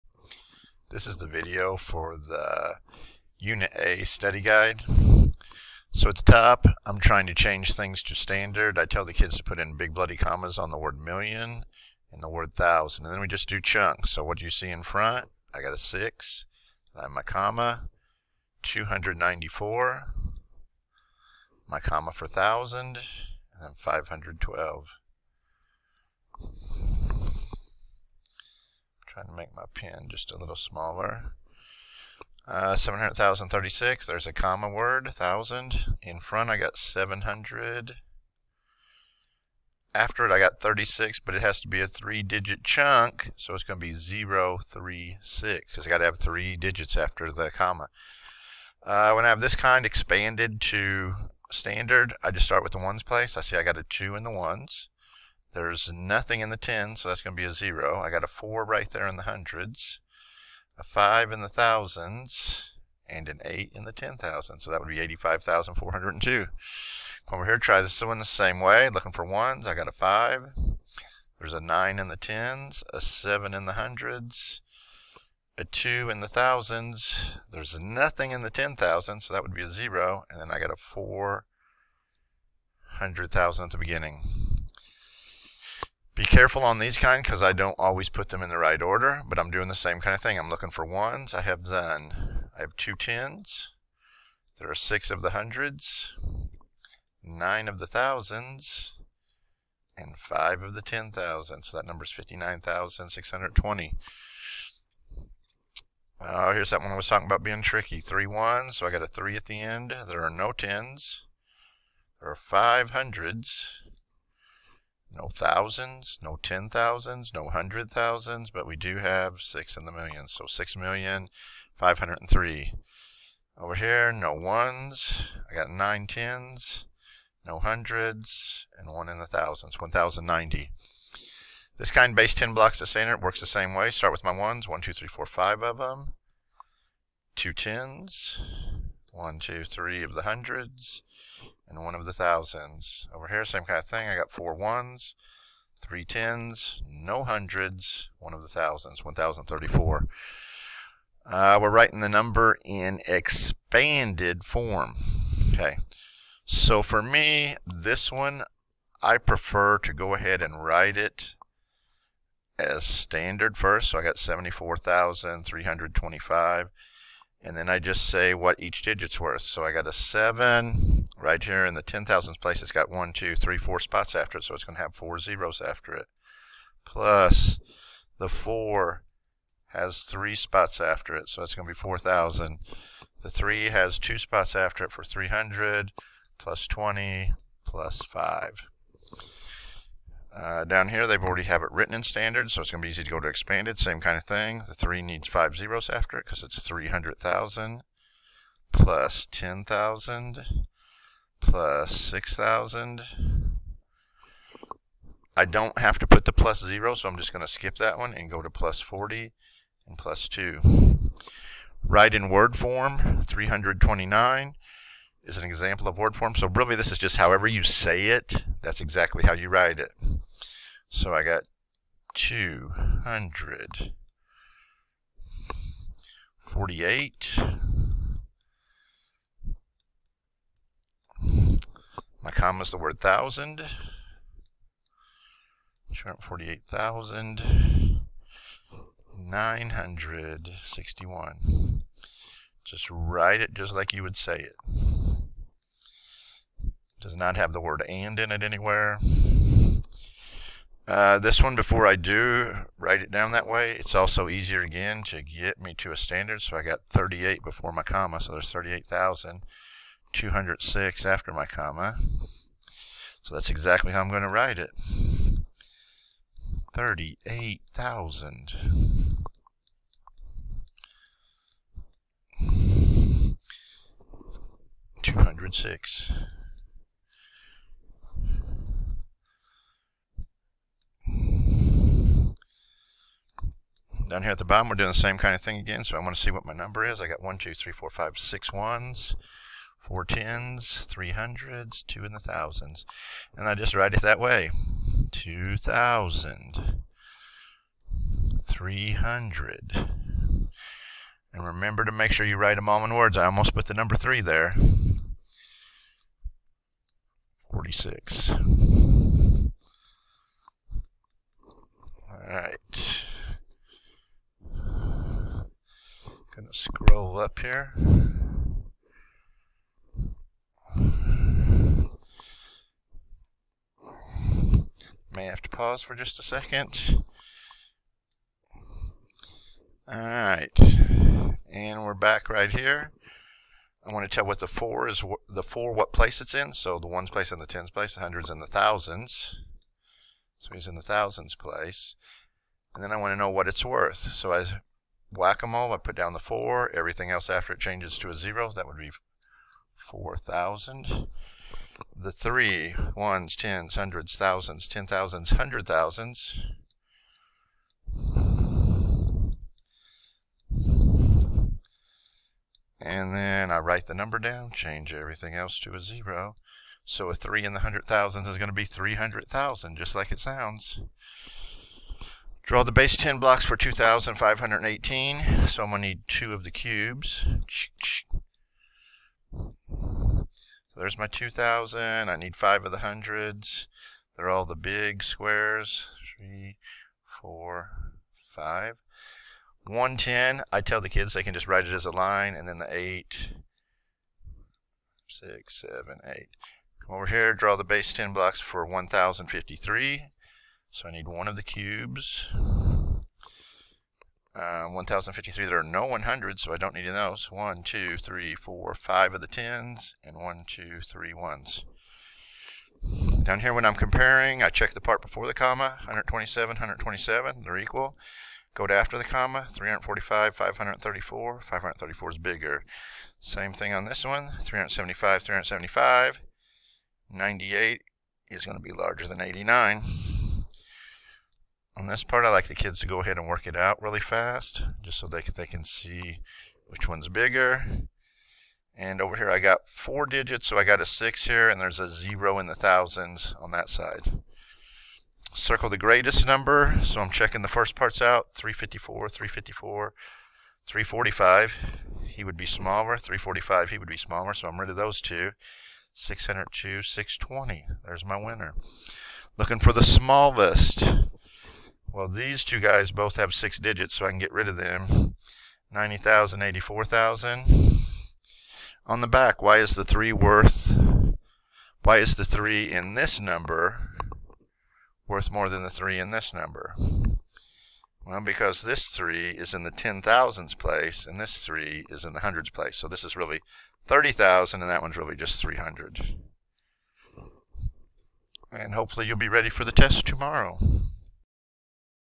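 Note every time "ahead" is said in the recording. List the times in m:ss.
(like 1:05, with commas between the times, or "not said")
2:40, 7:13.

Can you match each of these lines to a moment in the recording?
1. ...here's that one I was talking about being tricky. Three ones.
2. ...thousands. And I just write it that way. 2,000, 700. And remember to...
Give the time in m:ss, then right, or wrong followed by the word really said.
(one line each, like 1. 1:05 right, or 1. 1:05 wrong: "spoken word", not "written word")
1. 1:46 right
2. 4:52 wrong: "300", not "700".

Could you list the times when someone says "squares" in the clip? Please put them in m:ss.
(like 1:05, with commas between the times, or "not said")
6:25.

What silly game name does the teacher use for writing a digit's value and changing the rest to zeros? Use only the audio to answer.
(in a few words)
whack-a-mole.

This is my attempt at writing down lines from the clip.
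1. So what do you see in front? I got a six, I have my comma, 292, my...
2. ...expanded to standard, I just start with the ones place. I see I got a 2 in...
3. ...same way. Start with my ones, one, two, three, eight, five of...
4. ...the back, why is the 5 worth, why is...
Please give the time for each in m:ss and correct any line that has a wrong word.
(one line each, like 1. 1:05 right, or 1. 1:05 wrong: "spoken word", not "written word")
1. 0:14 wrong: "294", not "292"
2. 0:49 right
3. 2:13 wrong: "four", not "eight"
4. 7:49 wrong: "3", not "5".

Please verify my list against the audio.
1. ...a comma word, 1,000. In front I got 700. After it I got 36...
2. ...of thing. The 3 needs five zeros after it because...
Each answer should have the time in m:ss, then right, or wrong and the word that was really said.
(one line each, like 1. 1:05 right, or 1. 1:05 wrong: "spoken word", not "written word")
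1. 0:34 right
2. 3:14 right.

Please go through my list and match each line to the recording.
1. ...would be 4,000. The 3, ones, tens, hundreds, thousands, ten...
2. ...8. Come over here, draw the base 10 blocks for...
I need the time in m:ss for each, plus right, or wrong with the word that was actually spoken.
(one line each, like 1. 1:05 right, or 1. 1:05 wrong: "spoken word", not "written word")
1. 5:48 right
2. 6:36 right.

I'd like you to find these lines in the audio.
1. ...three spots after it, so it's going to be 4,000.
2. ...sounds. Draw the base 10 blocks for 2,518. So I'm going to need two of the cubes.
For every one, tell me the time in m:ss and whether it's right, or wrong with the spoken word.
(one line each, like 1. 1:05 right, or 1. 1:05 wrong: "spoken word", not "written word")
1. 3:00 right
2. 6:10 right.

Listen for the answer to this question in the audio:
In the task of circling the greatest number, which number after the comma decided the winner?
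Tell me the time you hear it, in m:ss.
7:36.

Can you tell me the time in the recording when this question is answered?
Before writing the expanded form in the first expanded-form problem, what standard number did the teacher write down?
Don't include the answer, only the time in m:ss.
2:44.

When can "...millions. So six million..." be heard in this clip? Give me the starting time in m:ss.
1:59.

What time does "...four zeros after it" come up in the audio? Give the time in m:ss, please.
2:54.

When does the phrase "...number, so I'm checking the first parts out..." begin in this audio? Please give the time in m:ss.
7:26.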